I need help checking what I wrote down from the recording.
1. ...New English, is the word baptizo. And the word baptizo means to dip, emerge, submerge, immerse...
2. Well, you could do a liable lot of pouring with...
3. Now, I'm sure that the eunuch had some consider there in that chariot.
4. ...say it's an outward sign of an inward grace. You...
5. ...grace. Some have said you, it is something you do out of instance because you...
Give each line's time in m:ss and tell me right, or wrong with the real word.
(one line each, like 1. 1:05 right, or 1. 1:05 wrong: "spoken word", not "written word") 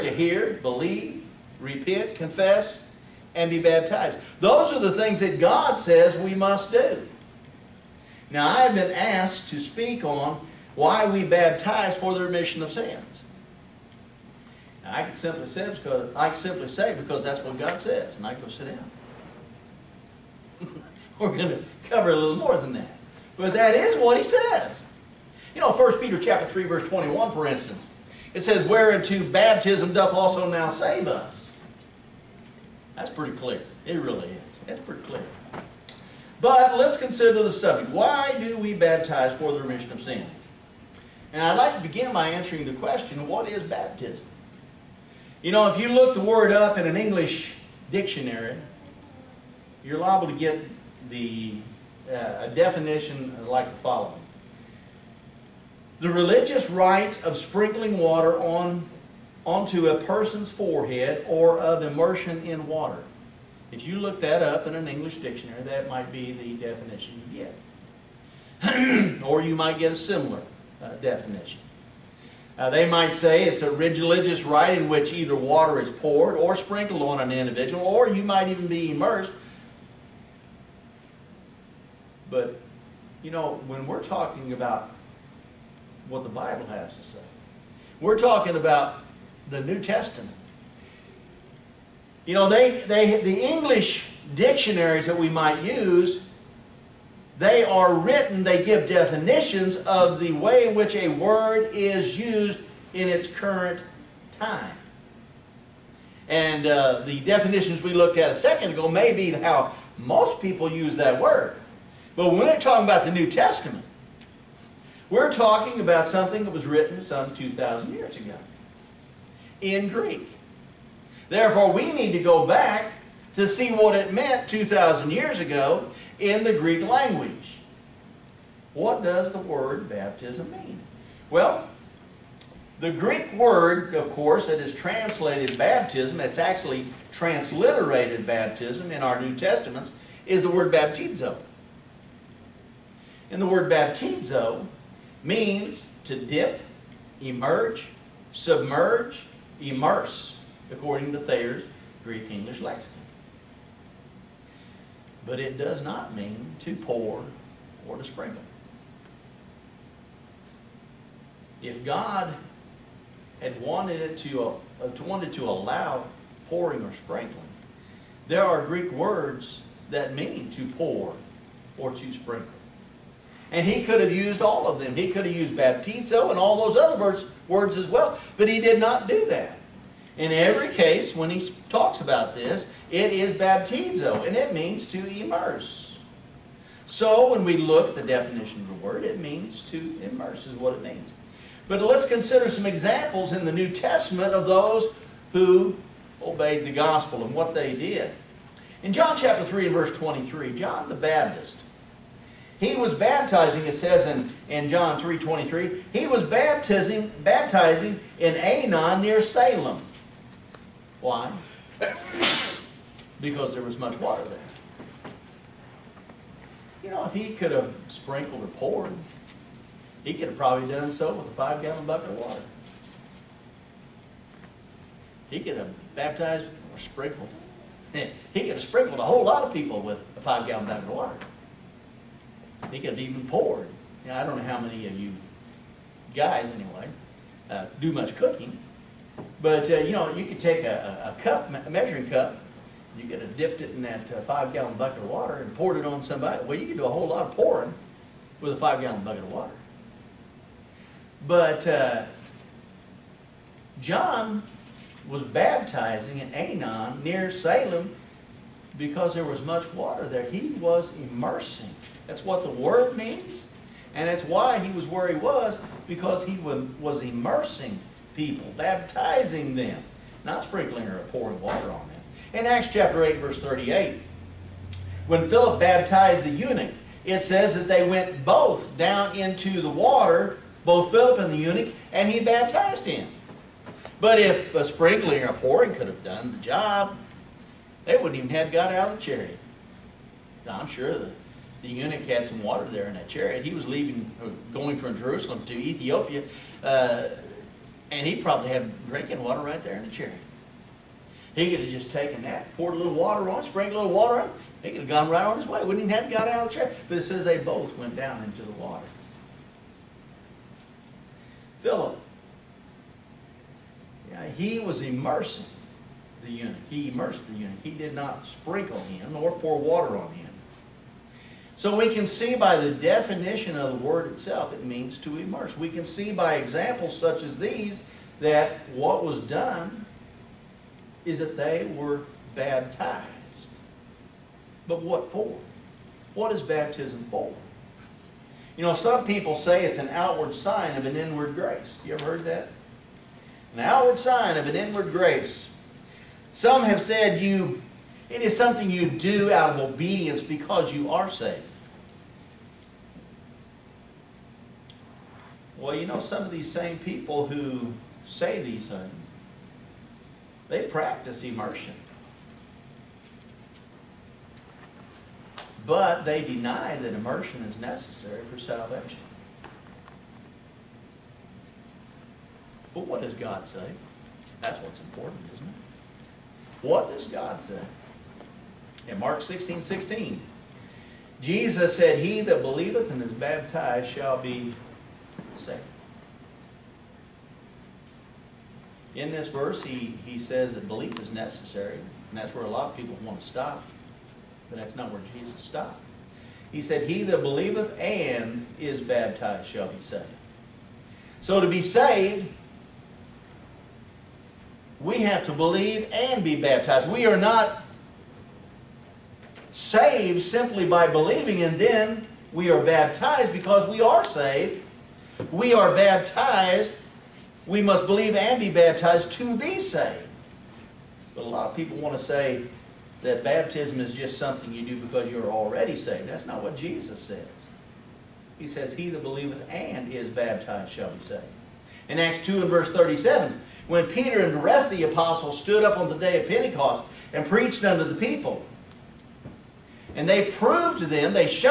1. 2:19 wrong: "Testaments", not "English"
2. 4:06 wrong: "whole", not "liable"
3. 4:50 wrong: "water", not "consider"
4. 5:39 right
5. 5:44 wrong: "obedience", not "instance".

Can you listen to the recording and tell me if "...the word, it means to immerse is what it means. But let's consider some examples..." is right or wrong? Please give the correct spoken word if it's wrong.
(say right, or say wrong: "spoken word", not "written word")
right.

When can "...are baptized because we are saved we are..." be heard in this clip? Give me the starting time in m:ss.
6:52.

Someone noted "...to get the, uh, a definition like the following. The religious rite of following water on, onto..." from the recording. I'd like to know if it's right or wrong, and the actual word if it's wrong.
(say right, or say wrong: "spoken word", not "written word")
wrong: "sprinkling", not "following".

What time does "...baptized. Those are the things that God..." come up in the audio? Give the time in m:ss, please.
0:03.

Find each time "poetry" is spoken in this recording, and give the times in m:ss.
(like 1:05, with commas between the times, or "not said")
not said.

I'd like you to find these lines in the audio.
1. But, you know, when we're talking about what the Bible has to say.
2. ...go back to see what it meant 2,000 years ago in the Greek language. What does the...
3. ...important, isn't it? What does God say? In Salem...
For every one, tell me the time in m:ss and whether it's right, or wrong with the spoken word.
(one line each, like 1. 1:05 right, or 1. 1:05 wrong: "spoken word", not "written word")
1. 1:22 right
2. 2:02 right
3. 6:14 wrong: "Mark", not "Salem".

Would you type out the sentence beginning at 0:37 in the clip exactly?
Why do we baptize for the remission of sins?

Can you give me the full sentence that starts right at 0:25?
You know, 1 Peter chapter 3, verse 21, for instance, it says, Whereunto baptism doth also now save us.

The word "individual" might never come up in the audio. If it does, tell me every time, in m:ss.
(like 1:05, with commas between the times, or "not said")
1:17.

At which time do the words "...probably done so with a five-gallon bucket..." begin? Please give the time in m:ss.
3:40.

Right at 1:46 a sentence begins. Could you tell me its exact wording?
And uh, the definitions we looked at a second ago may be how most people use that word.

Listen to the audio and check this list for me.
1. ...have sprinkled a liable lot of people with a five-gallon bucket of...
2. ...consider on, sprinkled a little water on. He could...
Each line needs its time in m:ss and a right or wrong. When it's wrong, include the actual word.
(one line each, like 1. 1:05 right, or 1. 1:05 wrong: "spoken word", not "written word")
1. 3:48 wrong: "whole", not "liable"
2. 5:02 wrong: "water", not "consider".